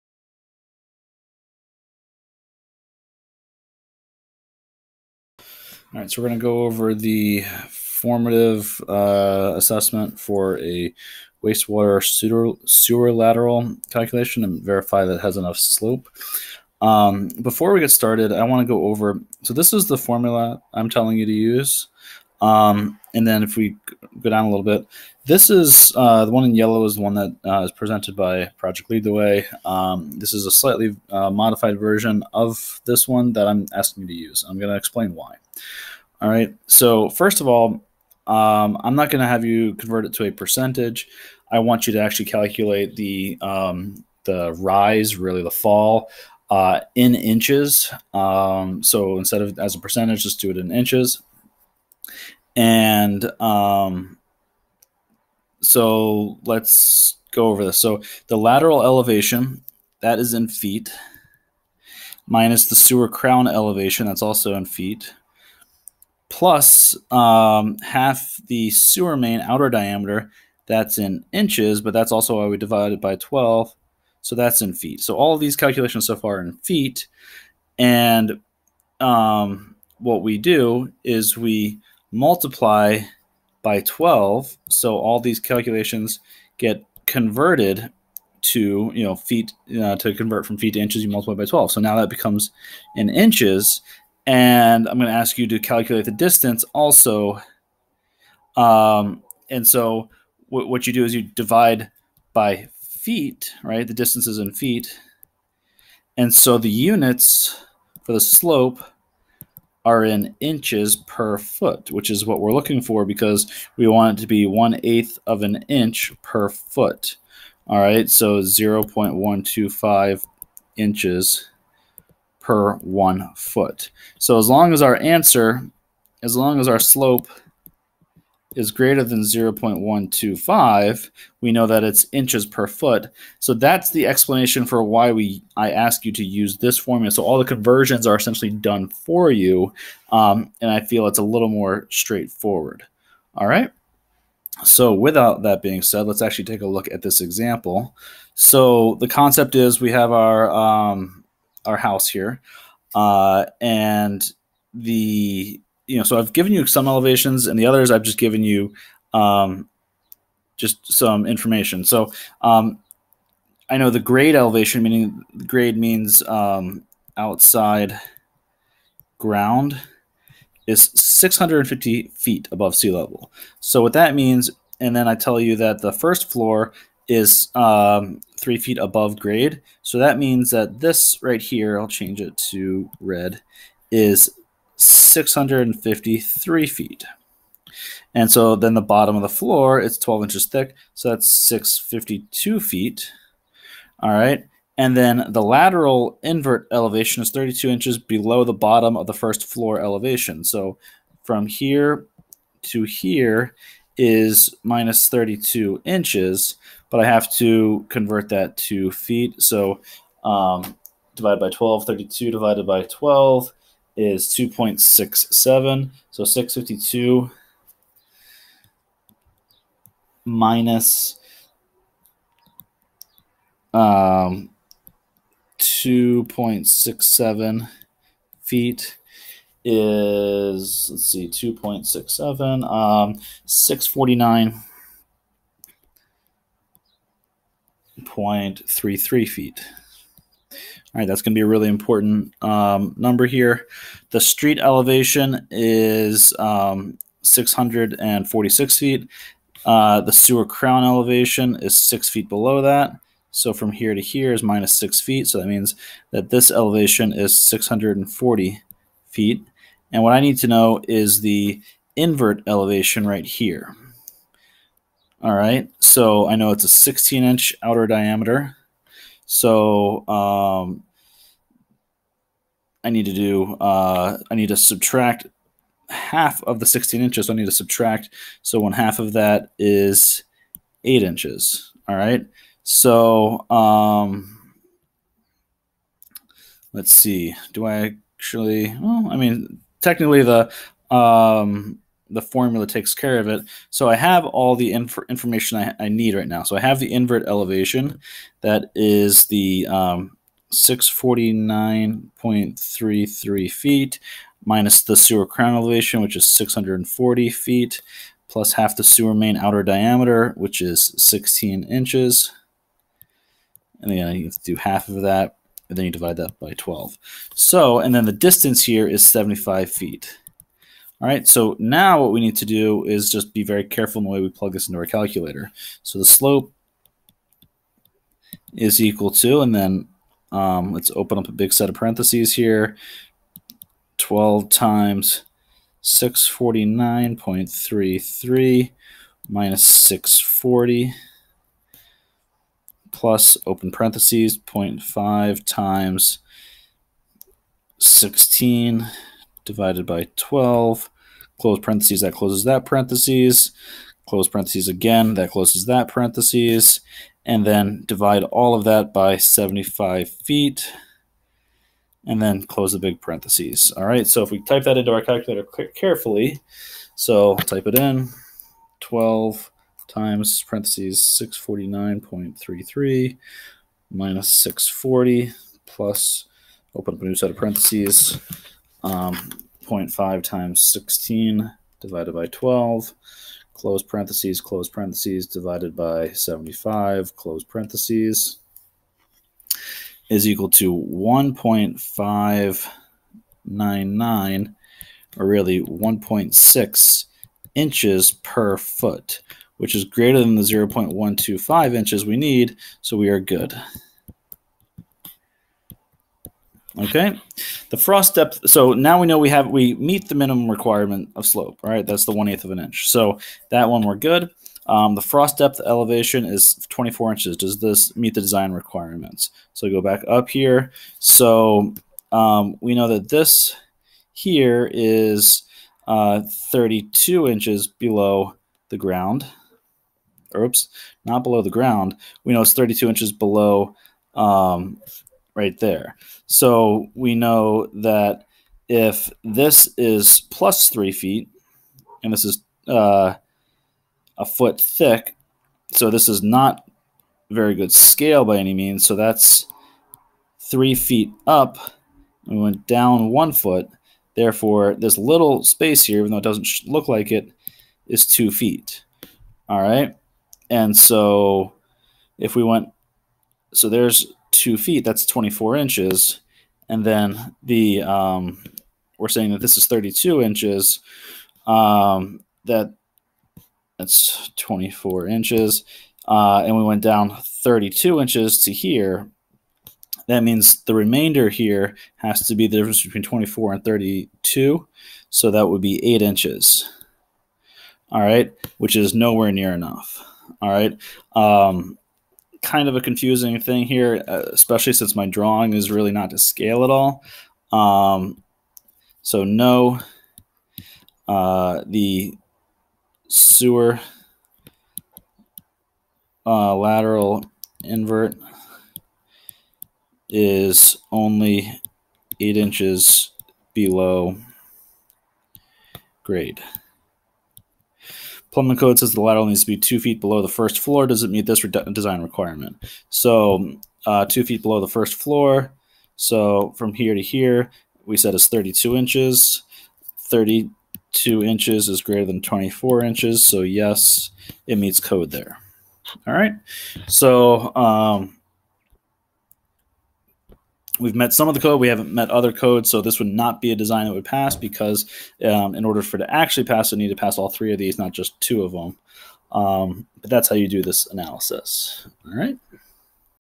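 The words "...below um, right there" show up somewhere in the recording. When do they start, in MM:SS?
07:13.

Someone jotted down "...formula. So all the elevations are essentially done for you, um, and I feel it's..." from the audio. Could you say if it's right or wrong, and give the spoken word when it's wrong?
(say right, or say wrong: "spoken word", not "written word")
wrong: "conversions", not "elevations".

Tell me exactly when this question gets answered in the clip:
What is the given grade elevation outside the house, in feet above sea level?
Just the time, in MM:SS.
02:50.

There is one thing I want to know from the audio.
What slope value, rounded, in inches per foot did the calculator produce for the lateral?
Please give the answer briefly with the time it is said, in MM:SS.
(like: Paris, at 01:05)
1.6 inches per foot, at 06:35.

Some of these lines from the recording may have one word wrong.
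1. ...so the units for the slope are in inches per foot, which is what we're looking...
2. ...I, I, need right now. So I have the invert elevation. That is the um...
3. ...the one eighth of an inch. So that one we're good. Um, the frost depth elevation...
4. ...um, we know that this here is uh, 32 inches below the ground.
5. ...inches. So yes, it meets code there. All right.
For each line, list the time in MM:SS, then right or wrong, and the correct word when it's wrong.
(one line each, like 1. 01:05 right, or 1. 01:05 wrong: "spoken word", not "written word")
1. 01:46 right
2. 04:55 right
3. 06:52 right
4. 07:02 right
5. 08:52 right.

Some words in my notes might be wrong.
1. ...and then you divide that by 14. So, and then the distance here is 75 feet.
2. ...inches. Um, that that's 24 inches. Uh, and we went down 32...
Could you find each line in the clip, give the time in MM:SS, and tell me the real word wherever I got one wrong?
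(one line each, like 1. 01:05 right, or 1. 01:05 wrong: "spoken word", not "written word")
1. 05:15 wrong: "12", not "14"
2. 07:50 right.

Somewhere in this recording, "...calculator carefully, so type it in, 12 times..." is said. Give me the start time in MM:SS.
06:04.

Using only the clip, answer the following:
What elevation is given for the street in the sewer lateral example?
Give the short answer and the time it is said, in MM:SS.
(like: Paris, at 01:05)
646 feet, at 04:07.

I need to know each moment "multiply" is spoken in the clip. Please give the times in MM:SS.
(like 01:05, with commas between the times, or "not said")
01:22, 01:31.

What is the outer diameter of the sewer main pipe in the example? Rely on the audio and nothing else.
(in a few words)
16 inches.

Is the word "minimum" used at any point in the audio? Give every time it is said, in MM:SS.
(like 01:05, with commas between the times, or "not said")
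06:50.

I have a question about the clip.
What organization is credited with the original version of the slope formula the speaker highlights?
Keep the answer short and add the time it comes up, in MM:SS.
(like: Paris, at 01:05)
Project Lead the Way, at 00:28.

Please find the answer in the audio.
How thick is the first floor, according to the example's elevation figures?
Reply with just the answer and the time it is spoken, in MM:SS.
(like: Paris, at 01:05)
12 inches, at 03:09.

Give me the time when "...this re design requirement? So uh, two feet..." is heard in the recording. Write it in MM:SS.
08:41.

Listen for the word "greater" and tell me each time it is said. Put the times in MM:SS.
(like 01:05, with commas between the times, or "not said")
02:08, 06:39, 08:51.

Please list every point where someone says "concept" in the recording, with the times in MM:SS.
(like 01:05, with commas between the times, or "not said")
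02:29.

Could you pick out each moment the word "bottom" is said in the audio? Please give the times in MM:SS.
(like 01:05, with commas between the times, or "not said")
03:08, 03:18.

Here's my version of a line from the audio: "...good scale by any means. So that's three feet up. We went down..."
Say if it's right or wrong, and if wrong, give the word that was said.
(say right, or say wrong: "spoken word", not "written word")
right.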